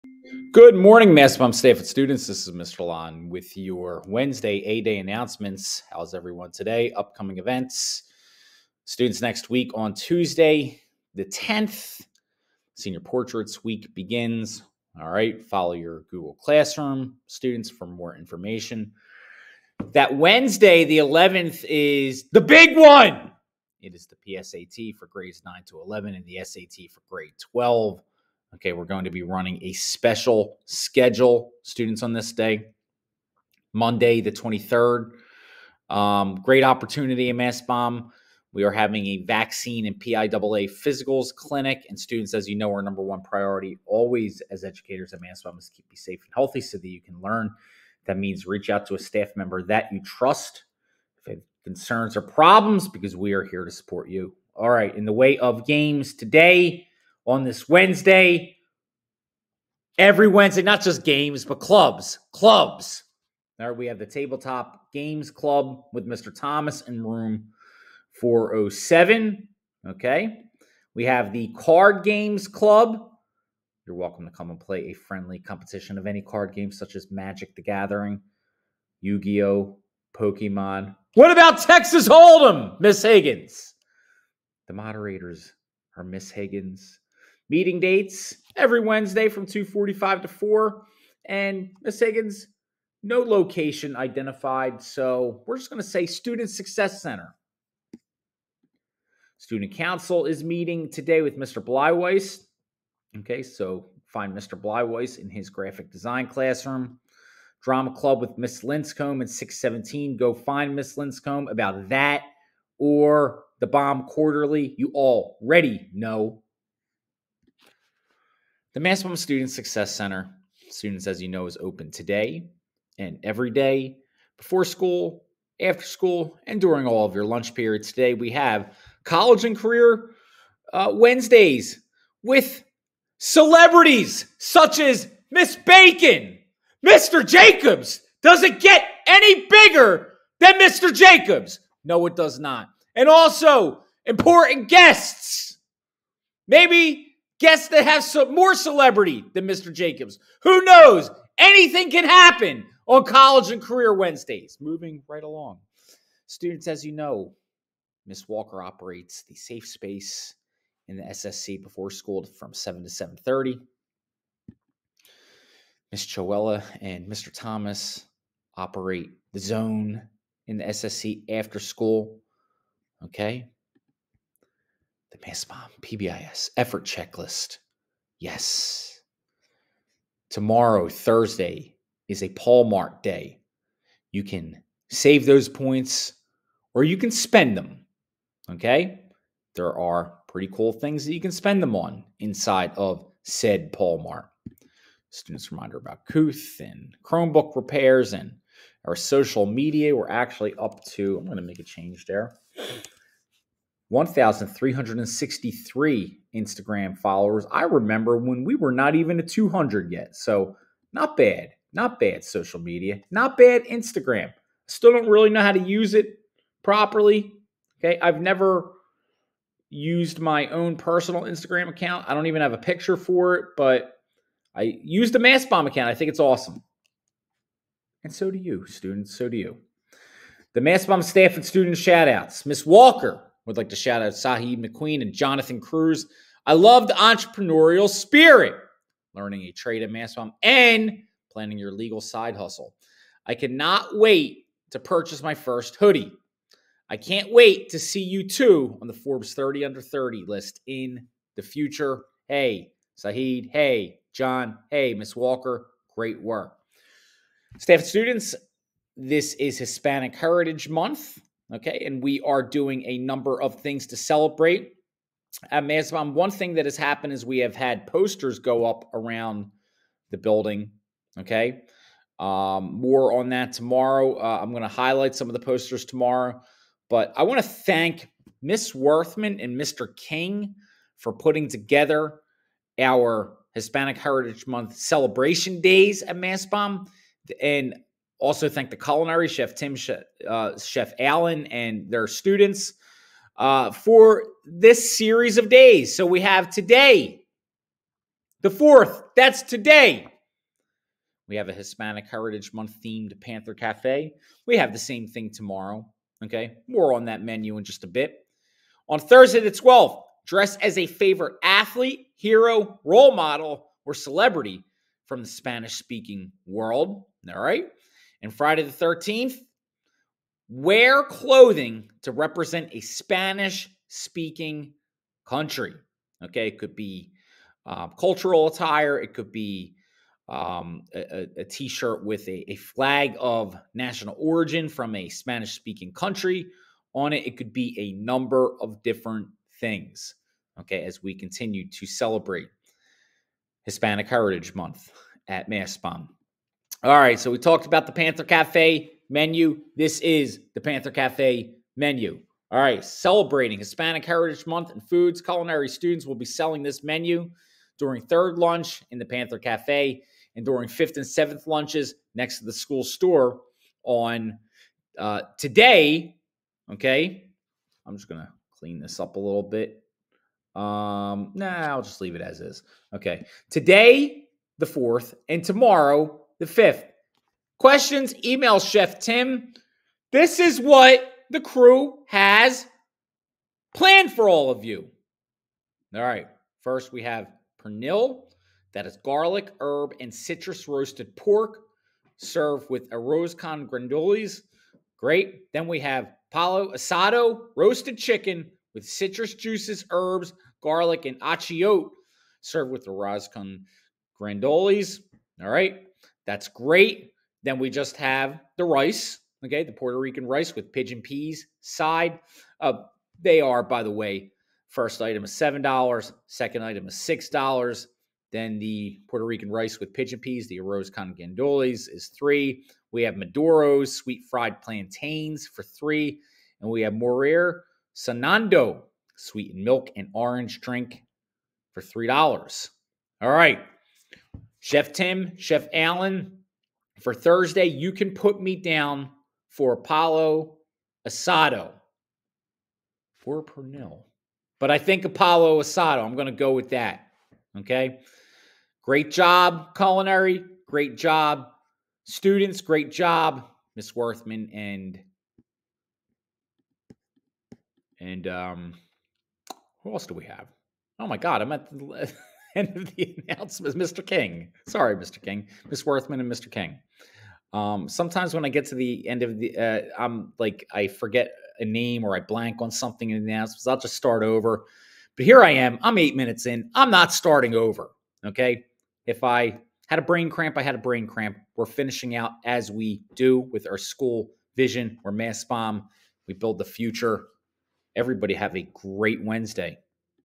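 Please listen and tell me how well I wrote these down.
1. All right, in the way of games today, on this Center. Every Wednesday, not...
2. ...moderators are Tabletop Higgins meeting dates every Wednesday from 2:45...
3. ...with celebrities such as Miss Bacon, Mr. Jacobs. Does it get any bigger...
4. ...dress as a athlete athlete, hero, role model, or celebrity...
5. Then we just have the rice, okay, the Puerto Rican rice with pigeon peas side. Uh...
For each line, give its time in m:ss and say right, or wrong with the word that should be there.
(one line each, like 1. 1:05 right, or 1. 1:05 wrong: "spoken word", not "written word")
1. 0:54 wrong: "Wednesday", not "Center"
2. 1:24 wrong: "Miss", not "Tabletop"
3. 2:12 right
4. 5:10 wrong: "favorite", not "athlete"
5. 6:47 right.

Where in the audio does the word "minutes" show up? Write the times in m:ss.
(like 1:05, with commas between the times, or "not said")
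7:56.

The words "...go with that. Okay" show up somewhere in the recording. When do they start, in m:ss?
7:26.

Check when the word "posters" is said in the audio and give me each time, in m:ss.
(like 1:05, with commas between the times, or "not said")
4:27, 4:35.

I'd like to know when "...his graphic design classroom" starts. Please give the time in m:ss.
1:45.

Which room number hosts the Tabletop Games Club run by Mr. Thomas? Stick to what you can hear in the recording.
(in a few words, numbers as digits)
407.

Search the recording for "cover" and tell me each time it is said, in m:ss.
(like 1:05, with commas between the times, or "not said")
not said.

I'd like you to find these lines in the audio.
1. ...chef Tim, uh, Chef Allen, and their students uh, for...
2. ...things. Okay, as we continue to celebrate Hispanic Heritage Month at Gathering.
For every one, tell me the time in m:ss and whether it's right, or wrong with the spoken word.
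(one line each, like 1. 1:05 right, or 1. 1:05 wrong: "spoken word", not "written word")
1. 4:49 right
2. 5:39 wrong: "Mastbaum", not "Gathering".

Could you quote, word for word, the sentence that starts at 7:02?
We have Maduros, sweet fried plantains for three.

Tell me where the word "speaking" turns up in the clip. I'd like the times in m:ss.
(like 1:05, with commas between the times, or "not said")
5:15, 5:23, 5:35.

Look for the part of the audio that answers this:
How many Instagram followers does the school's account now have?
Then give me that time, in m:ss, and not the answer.
3:23.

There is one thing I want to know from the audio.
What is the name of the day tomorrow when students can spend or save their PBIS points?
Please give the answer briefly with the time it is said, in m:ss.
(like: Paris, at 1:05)
Paul Mart day, at 3:02.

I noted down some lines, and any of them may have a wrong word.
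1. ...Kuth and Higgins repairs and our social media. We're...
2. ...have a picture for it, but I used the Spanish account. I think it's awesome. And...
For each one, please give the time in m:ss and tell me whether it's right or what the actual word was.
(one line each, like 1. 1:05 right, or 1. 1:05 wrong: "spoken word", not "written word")
1. 3:16 wrong: "Chromebook", not "Higgins"
2. 3:42 wrong: "Mastbaum", not "Spanish".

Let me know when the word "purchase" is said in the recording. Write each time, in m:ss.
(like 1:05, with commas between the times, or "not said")
4:04.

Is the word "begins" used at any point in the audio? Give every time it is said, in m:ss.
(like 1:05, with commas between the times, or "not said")
0:13.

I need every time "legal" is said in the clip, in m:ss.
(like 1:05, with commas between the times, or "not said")
4:01.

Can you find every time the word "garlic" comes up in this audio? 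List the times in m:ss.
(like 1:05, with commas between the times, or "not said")
6:29, 6:40.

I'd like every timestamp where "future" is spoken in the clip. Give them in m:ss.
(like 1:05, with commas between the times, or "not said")
4:11, 8:06.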